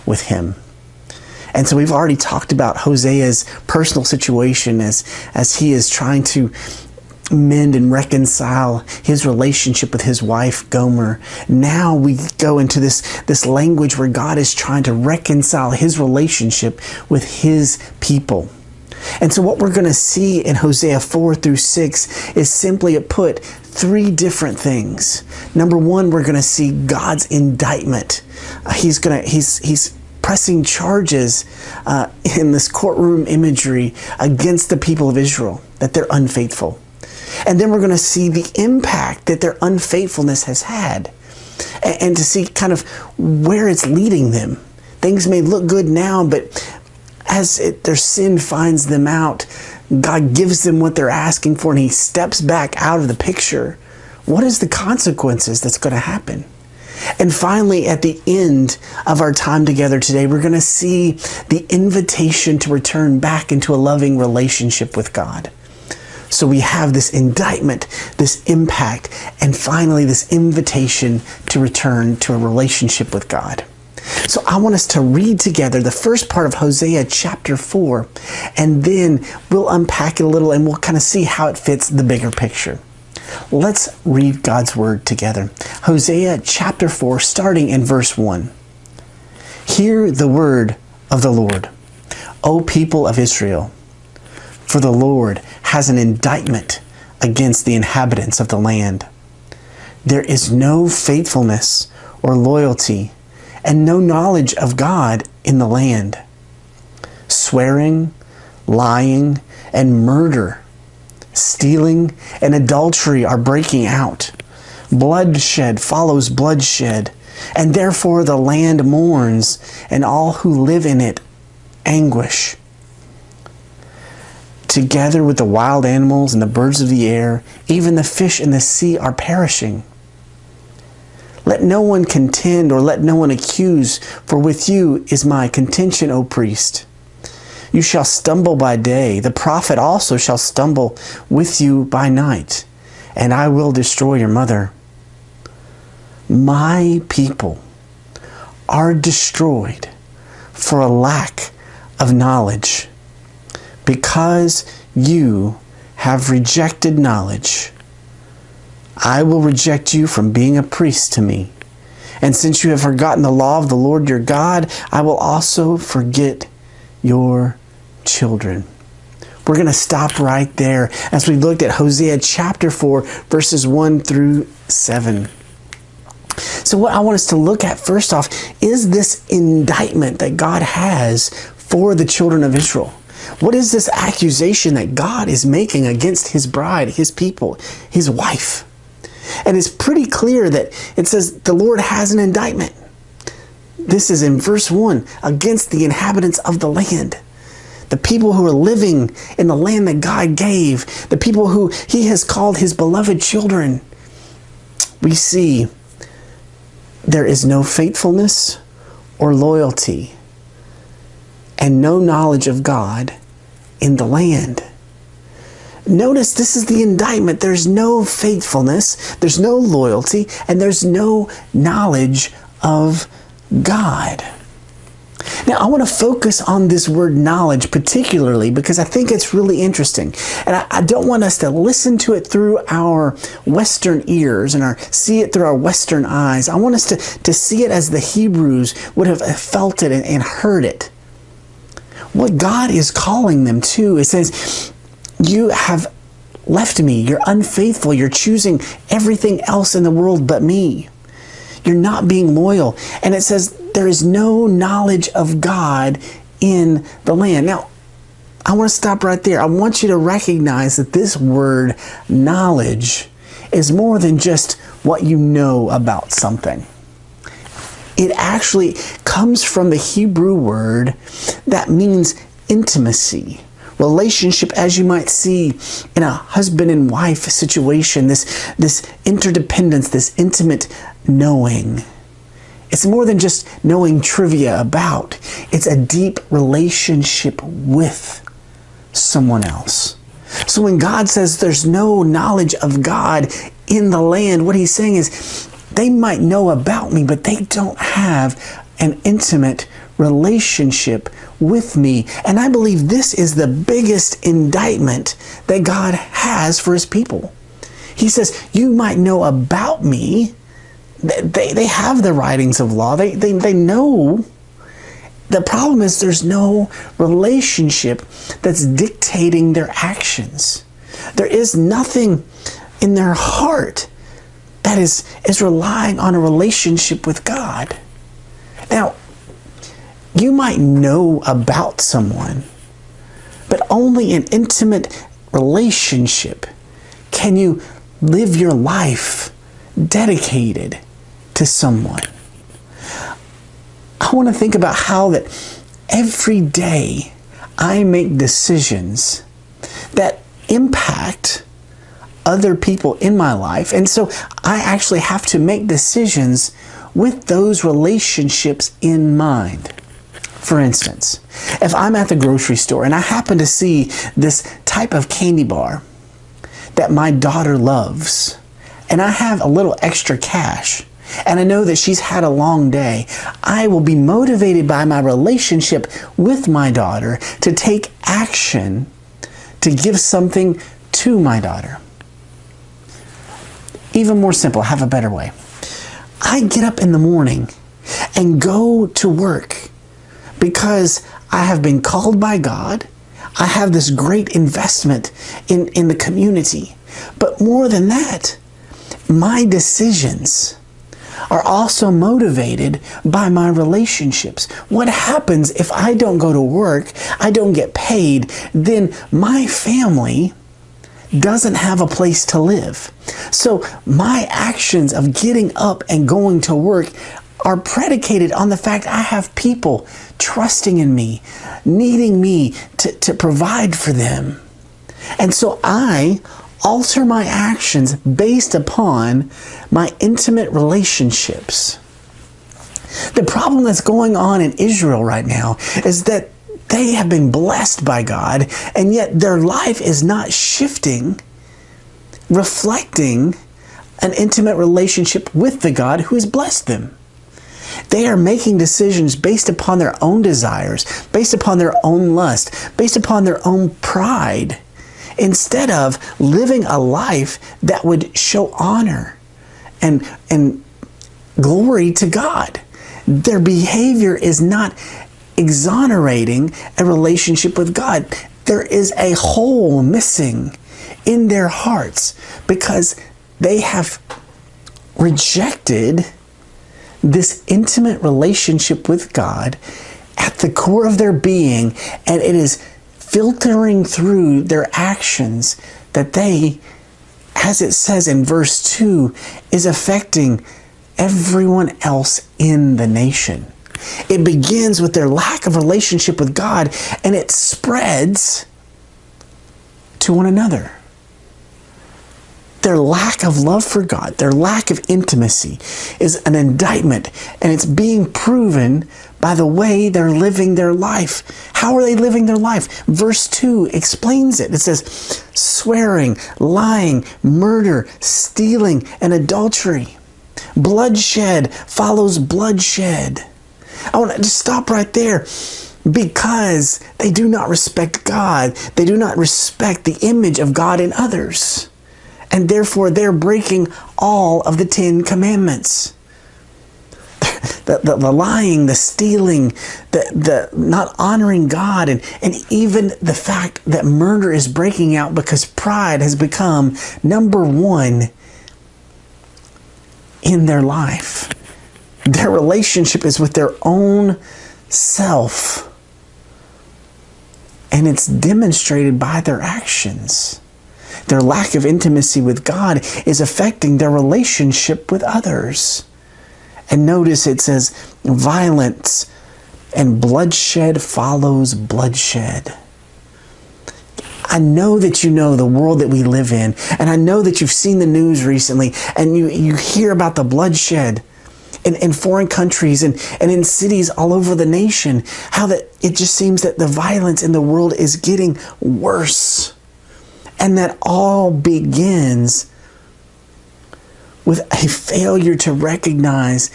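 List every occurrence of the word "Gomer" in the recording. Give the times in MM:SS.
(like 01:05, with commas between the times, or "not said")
00:10.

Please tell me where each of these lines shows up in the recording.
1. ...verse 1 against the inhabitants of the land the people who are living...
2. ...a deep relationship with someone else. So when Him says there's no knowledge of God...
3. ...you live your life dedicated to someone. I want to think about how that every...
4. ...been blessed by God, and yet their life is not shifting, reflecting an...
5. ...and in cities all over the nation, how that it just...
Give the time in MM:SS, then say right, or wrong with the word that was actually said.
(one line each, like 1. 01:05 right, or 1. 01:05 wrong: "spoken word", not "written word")
1. 03:14 right
2. 04:45 wrong: "God", not "Him"
3. 05:37 right
4. 07:17 right
5. 09:43 right.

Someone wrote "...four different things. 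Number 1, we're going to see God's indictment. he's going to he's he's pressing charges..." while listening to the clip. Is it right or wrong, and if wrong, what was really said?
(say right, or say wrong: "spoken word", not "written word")
wrong: "three", not "four".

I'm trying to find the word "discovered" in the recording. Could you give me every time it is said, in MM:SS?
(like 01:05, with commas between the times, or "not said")
not said.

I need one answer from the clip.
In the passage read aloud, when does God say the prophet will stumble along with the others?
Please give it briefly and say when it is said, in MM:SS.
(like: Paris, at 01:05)
by night, at 02:21.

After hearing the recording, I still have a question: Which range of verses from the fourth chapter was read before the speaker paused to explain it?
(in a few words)
1 through 7.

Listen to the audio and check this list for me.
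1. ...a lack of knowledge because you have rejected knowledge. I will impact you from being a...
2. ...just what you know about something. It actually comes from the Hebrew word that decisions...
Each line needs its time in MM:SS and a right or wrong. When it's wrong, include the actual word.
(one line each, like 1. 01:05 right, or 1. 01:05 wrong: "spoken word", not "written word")
1. 02:30 wrong: "reject", not "impact"
2. 04:24 wrong: "means", not "decisions".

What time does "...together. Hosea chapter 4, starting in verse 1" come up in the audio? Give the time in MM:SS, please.
01:25.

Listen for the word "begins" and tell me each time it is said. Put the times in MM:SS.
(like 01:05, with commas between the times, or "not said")
08:14, 09:51.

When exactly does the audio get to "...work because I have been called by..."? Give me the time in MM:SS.
06:29.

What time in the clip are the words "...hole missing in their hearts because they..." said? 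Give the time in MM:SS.
07:49.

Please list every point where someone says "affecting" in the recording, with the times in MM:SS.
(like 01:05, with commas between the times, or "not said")
08:09, 09:23.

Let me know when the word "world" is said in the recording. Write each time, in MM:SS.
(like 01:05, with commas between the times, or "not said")
04:09, 09:35, 09:47.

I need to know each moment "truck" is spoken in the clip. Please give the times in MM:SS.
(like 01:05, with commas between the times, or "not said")
not said.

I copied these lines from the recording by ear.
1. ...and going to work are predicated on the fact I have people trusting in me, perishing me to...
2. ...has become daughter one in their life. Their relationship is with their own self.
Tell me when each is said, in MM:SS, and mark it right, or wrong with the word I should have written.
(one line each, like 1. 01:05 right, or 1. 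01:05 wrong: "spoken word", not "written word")
1. 06:55 wrong: "needing", not "perishing"
2. 09:06 wrong: "number", not "daughter".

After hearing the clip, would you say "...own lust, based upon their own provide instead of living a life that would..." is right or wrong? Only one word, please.
wrong.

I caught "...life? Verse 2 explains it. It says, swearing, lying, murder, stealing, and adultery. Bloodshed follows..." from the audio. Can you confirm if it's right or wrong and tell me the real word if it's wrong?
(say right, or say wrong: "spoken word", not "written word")
right.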